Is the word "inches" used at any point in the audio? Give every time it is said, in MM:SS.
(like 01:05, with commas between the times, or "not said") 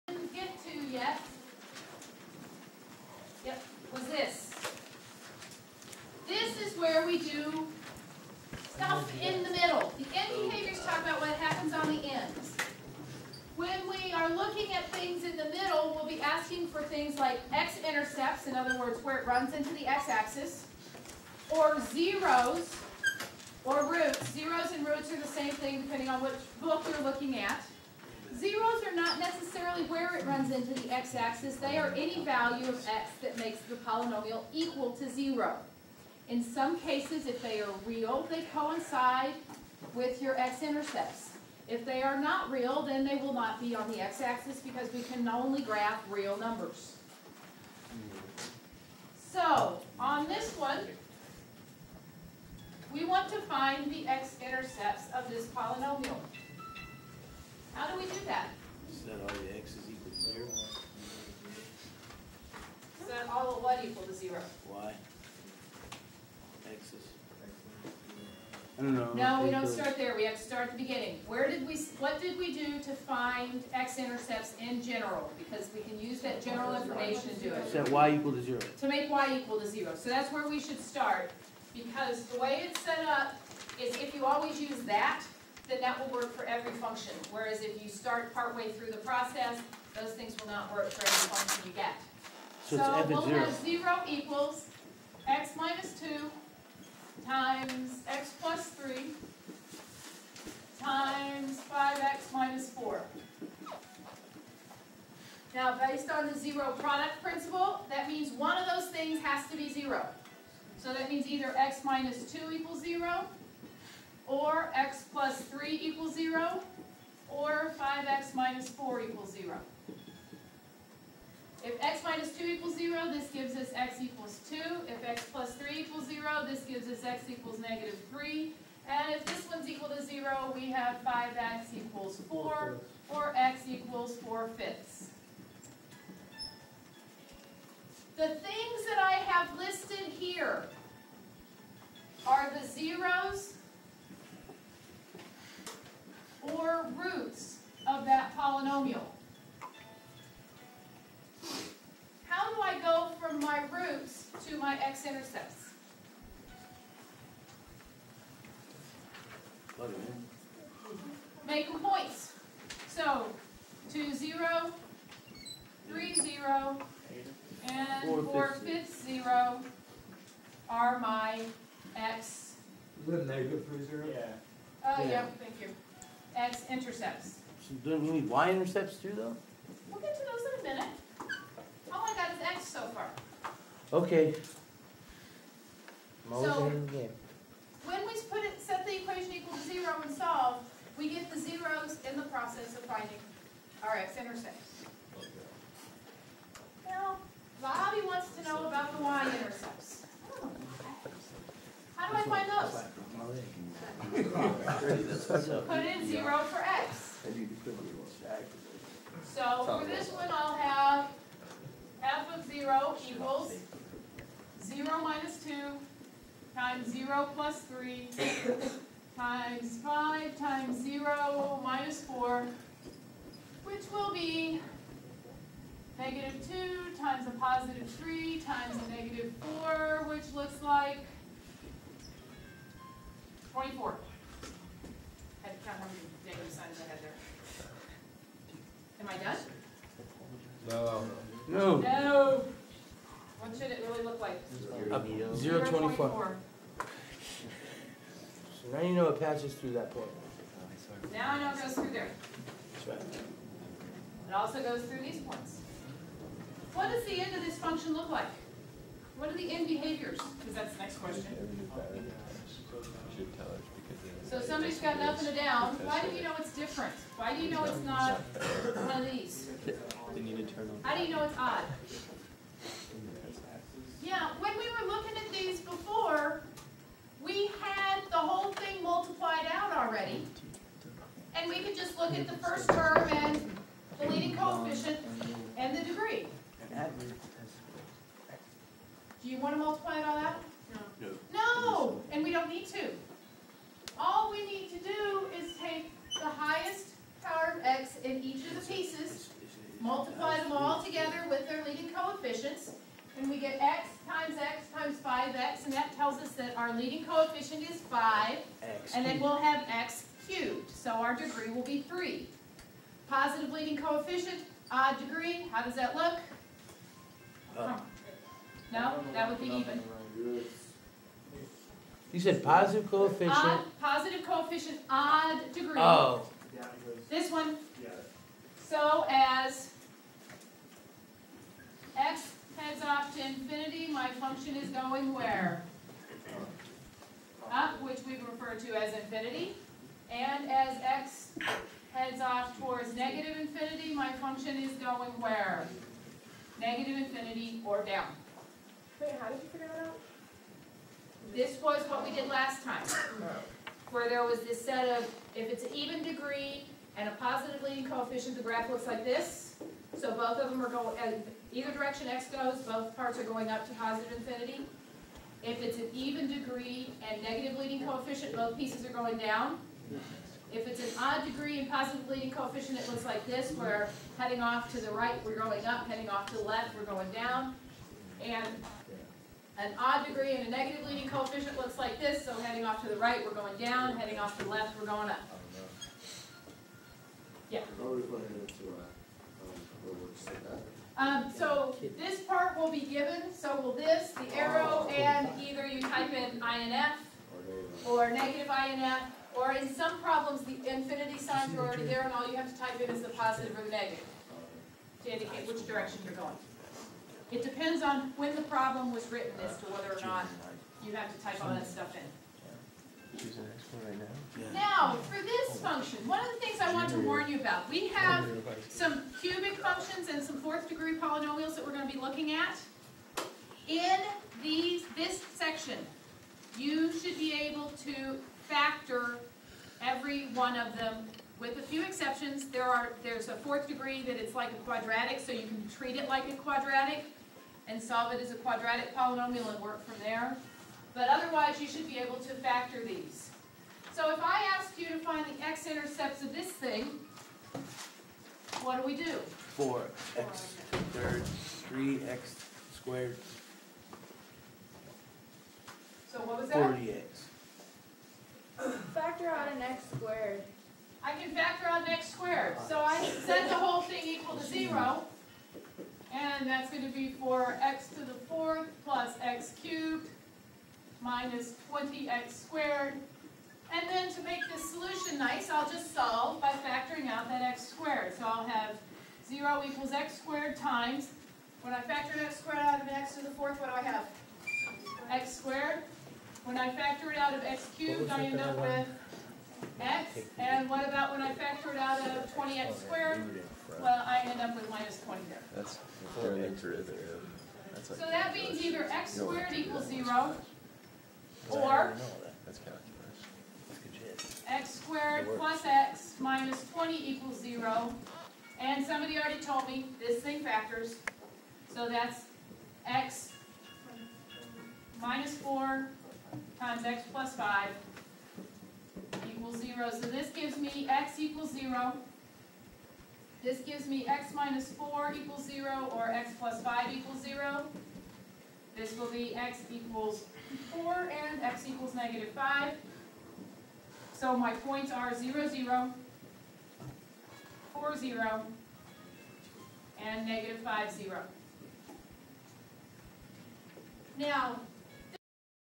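not said.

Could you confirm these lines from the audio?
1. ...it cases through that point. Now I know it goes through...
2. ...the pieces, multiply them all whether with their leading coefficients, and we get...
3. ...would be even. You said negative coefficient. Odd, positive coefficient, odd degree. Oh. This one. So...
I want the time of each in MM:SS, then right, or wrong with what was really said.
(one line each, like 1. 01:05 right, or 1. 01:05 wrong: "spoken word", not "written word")
1. 04:09 wrong: "passes", not "cases"
2. 04:58 wrong: "together", not "whether"
3. 05:19 wrong: "positive", not "negative".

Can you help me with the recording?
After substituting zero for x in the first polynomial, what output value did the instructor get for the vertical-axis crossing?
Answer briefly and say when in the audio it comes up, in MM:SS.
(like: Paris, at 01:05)
24, at 03:53.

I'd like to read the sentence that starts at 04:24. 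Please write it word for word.
So somebody's got an up and a down.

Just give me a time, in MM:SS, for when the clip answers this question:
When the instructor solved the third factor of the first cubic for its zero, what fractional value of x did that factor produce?
02:13.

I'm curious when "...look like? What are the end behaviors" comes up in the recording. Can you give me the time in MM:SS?
04:17.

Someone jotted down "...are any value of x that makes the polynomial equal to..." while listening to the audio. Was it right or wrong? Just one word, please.
right.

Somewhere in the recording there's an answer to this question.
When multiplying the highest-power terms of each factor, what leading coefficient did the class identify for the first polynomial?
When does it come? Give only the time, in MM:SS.
05:06.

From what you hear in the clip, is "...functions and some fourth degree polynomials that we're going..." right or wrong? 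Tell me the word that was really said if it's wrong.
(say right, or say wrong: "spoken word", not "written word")
right.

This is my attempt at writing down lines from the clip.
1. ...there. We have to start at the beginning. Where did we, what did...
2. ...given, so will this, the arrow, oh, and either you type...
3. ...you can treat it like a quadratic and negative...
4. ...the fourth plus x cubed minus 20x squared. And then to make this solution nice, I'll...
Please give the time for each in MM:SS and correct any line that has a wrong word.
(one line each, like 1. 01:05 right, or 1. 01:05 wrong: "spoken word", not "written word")
1. 01:09 right
2. 06:32 right
3. 07:15 wrong: "solve", not "negative"
4. 07:48 right.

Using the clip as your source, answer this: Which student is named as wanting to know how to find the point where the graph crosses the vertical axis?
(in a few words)
Bobby.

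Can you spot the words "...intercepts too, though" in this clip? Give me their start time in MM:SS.
02:58.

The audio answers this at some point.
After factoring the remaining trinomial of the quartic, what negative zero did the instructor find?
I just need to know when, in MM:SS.
08:51.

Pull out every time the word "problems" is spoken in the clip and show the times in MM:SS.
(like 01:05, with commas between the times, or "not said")
06:40, 06:48.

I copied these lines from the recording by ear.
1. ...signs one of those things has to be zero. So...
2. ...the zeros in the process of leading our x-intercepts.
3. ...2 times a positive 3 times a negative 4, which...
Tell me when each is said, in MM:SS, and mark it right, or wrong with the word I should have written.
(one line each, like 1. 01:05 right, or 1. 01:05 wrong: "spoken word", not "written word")
1. 01:48 wrong: "means", not "signs"
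2. 03:11 wrong: "finding", not "leading"
3. 03:46 right.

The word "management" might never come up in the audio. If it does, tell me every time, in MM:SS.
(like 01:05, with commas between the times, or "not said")
not said.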